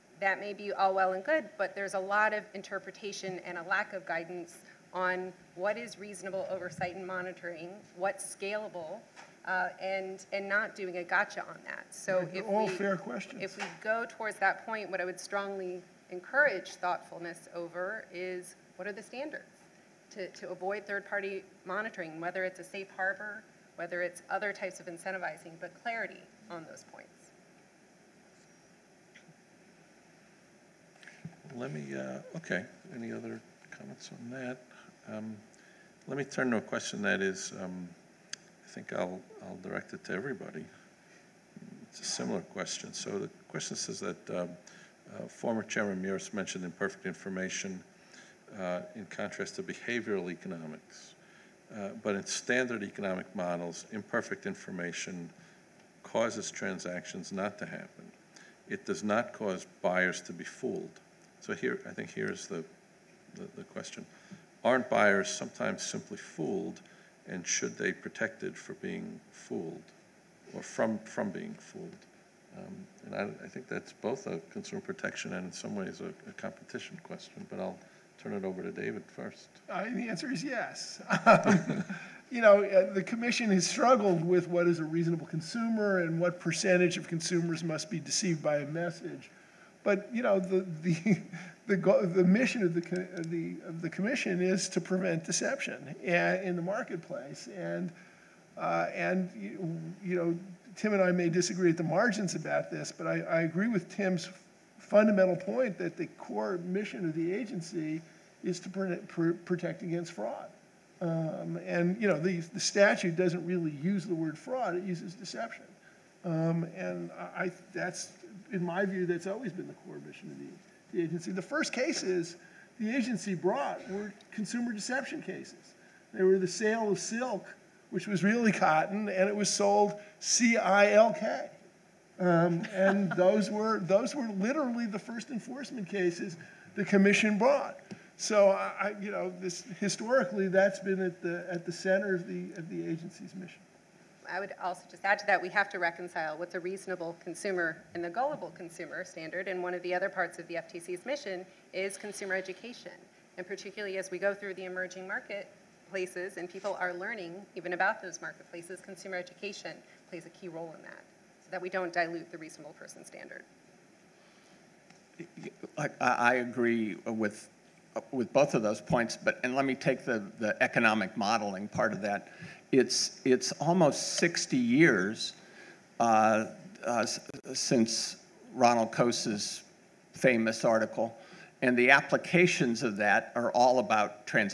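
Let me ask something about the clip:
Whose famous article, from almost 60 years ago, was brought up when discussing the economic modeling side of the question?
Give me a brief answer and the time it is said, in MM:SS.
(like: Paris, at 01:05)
Ronald Coase, at 02:58.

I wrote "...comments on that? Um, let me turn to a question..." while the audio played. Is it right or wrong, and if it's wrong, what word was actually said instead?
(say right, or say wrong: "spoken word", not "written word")
right.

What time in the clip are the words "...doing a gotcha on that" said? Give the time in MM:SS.
00:10.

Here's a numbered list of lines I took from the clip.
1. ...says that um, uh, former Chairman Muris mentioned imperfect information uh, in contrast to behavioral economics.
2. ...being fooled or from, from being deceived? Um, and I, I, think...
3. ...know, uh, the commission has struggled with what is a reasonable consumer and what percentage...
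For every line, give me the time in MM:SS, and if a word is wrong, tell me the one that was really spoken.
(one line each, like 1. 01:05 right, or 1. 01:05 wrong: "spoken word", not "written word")
1. 00:43 right
2. 01:08 wrong: "fooled", not "deceived"
3. 01:22 right.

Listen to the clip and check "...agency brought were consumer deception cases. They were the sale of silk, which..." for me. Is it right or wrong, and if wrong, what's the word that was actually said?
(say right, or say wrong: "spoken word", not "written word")
right.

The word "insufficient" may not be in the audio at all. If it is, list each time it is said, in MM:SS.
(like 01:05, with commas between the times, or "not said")
not said.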